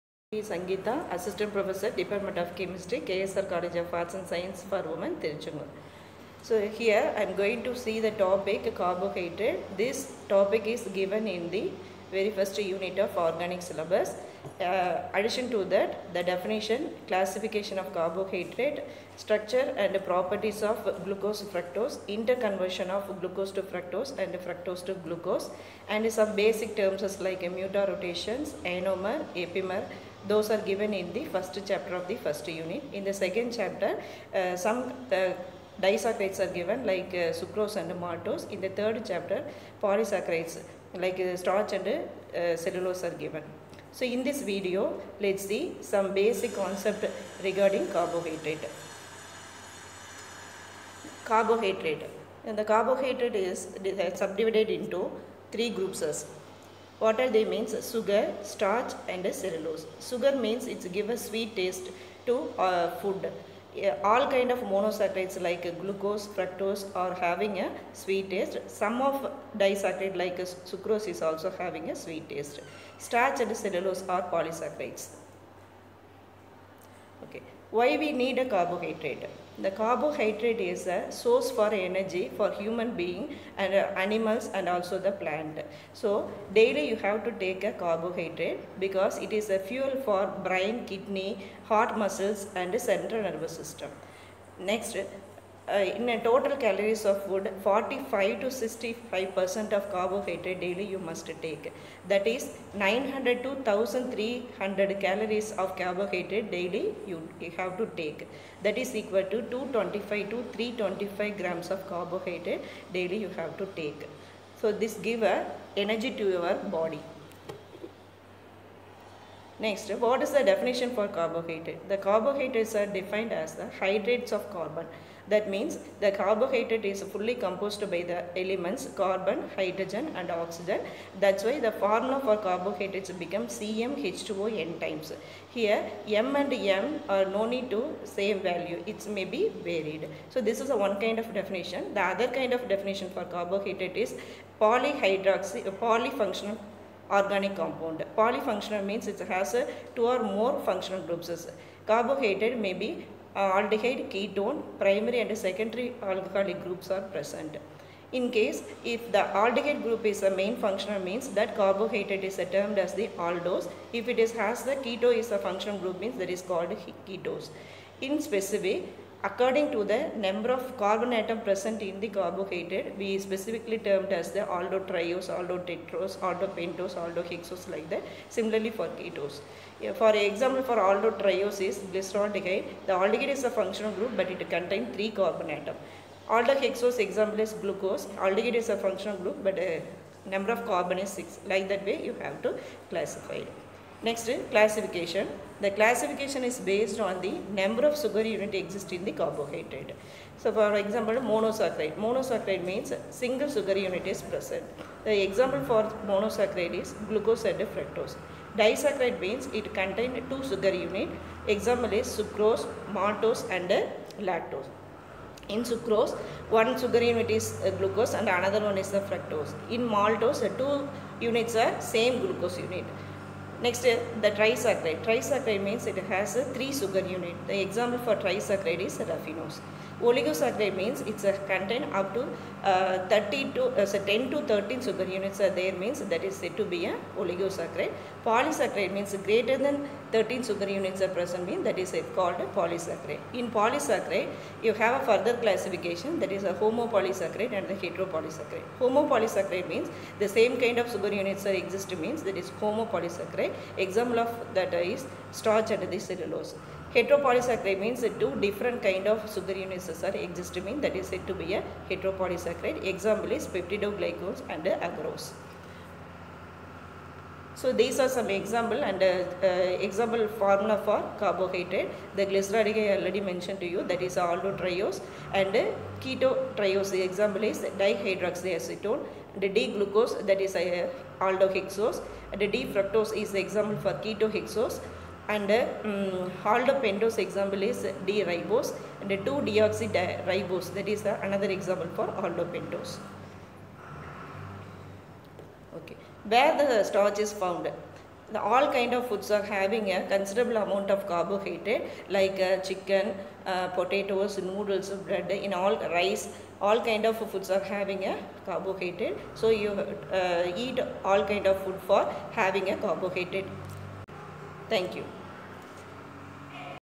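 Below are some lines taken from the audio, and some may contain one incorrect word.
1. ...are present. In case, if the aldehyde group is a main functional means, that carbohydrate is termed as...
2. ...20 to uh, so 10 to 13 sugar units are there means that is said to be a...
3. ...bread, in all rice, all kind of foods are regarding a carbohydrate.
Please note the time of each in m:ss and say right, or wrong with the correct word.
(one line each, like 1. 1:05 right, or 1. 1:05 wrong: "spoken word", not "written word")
1. 2:36 right
2. 3:53 wrong: "30", not "20"
3. 5:04 wrong: "having", not "regarding".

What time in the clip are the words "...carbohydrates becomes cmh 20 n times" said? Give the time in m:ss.
2:12.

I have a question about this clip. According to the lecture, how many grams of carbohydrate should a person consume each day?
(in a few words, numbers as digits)
225 to 325 grams.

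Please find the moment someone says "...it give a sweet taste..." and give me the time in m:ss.
1:00.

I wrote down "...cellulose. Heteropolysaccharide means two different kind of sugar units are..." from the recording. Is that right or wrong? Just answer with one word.
right.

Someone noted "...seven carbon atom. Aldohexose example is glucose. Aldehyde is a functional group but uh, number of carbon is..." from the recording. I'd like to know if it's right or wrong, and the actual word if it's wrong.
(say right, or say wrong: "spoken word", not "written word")
wrong: "three", not "seven".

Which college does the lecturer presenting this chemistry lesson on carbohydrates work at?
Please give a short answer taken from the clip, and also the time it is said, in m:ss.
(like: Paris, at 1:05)
KSR College of Arts and Science for Women, at 0:03.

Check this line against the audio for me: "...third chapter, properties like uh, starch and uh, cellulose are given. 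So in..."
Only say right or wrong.
wrong.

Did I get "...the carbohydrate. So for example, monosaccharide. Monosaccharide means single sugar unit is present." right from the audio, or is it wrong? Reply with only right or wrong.
right.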